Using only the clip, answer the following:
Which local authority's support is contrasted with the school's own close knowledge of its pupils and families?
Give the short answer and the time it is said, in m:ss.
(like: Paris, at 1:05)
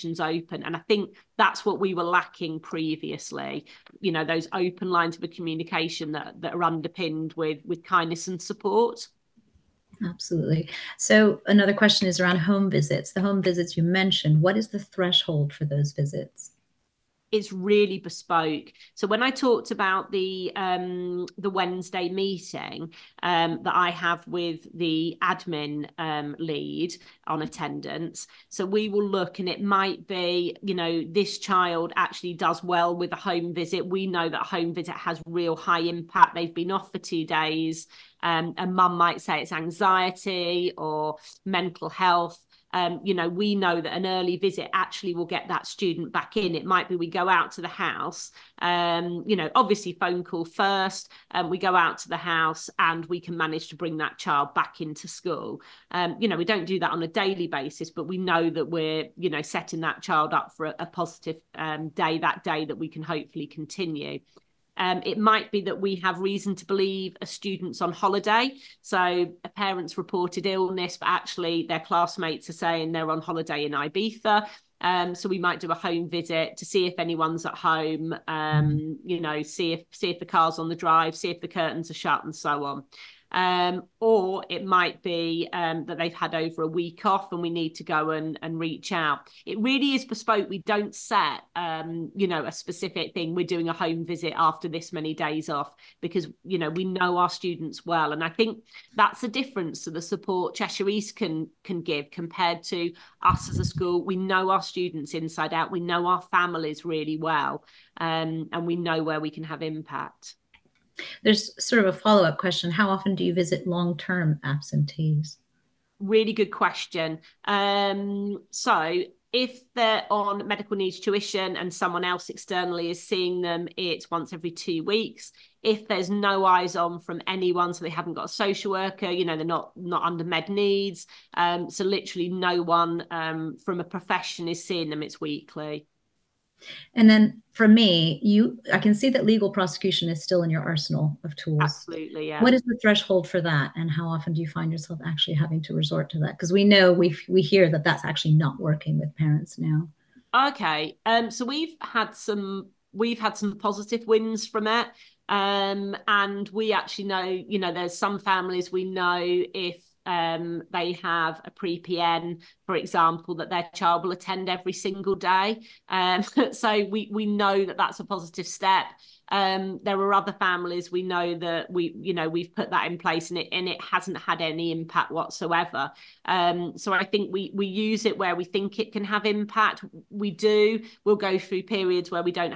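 Cheshire East, at 1:40.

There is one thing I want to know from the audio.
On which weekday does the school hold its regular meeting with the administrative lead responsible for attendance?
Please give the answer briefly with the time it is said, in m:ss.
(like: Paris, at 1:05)
Wednesday, at 0:21.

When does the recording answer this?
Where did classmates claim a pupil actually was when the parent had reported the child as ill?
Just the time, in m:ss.
1:13.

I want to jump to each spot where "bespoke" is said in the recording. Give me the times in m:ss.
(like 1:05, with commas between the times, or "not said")
0:17, 1:30.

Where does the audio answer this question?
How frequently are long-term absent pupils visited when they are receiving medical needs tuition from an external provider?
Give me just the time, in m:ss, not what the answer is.
2:04.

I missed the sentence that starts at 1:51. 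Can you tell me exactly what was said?
There's sort of a follow up question.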